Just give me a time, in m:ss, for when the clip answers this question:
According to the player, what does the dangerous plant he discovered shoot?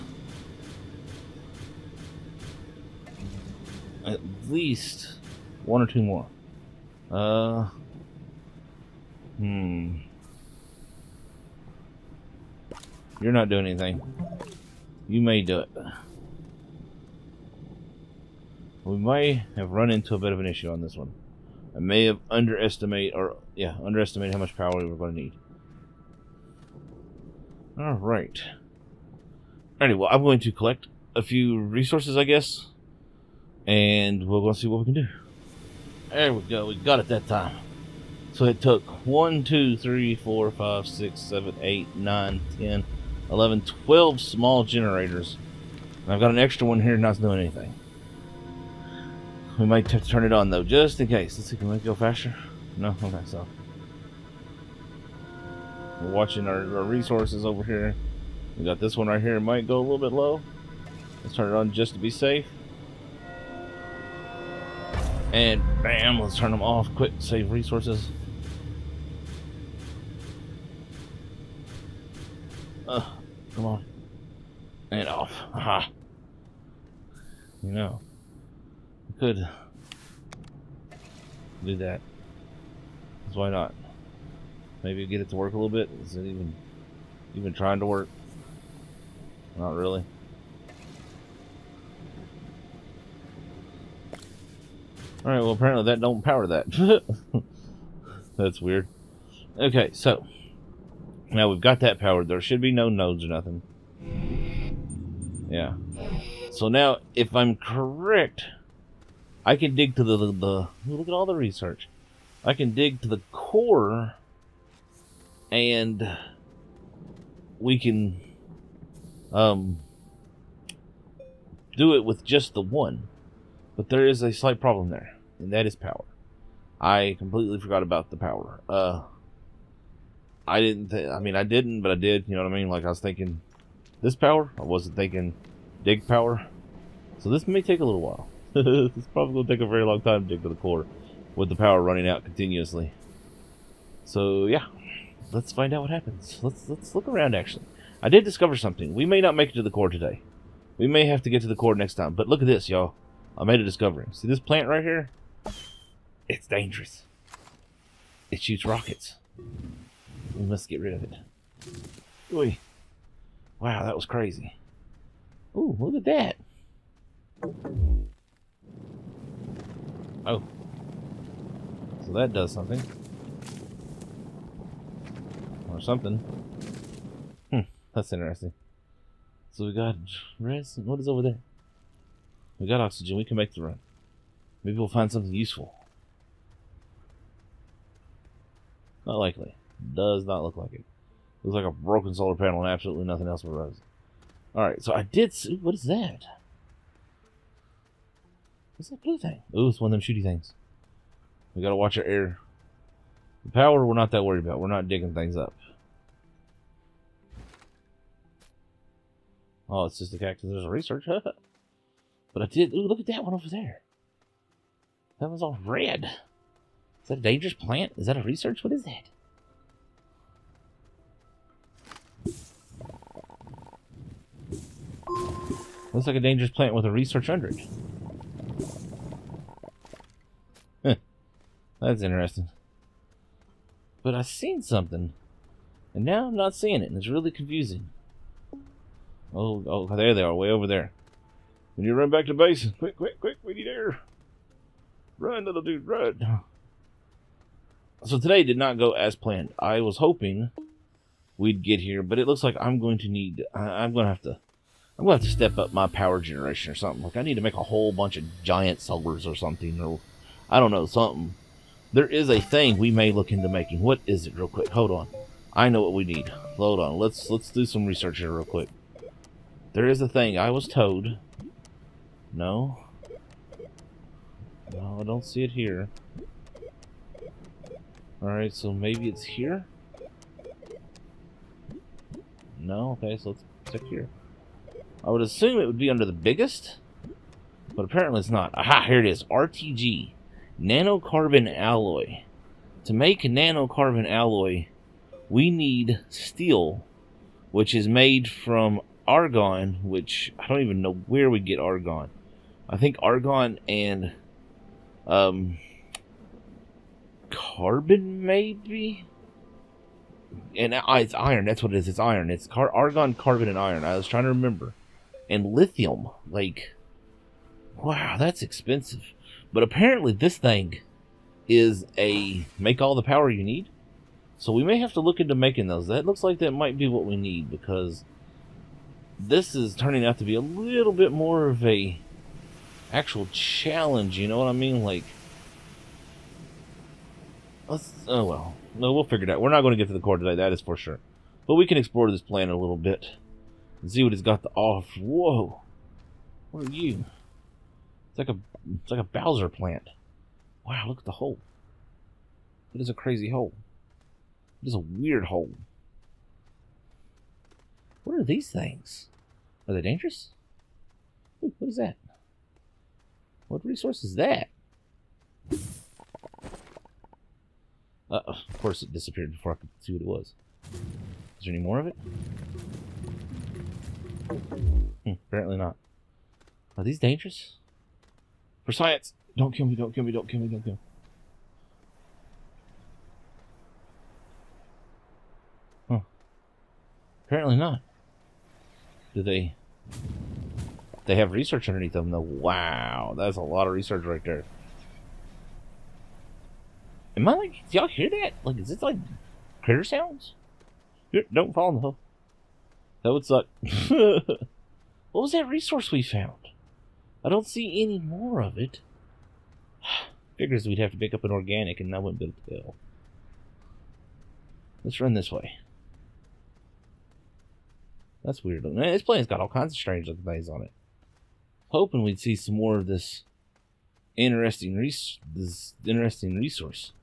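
2:38.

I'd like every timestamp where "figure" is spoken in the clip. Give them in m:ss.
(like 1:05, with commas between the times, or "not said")
5:39, 6:50.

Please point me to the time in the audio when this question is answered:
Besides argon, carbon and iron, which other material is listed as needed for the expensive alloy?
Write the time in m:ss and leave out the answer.
5:15.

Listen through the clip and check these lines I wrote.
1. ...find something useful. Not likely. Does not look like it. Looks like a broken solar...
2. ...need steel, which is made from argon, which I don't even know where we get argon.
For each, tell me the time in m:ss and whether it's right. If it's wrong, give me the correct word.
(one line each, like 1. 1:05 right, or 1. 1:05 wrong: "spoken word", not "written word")
1. 3:04 right
2. 4:55 right.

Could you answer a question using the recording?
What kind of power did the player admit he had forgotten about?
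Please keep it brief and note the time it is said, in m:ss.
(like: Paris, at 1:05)
dig power, at 2:15.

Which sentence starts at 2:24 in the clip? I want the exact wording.
So yeah, let's find out what happens.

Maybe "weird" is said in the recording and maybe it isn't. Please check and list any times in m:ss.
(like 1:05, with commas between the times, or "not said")
1:38, 5:54, 6:58.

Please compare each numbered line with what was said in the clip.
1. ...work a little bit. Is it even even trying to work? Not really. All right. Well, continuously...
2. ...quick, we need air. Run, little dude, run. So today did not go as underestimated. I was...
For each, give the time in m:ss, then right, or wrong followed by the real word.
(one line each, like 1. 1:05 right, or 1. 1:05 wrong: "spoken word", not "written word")
1. 1:25 wrong: "apparently", not "continuously"
2. 4:03 wrong: "planned", not "underestimated".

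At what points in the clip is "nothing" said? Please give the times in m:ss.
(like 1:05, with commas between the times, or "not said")
1:43, 3:13.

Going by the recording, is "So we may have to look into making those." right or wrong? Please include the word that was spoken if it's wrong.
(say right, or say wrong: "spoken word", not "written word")
right.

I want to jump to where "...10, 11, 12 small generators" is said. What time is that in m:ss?
0:42.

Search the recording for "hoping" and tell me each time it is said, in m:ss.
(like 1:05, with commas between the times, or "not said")
4:09, 7:01.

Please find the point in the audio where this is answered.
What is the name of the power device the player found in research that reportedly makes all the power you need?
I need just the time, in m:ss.
4:49.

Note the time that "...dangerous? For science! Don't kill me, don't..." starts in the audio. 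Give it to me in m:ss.
6:16.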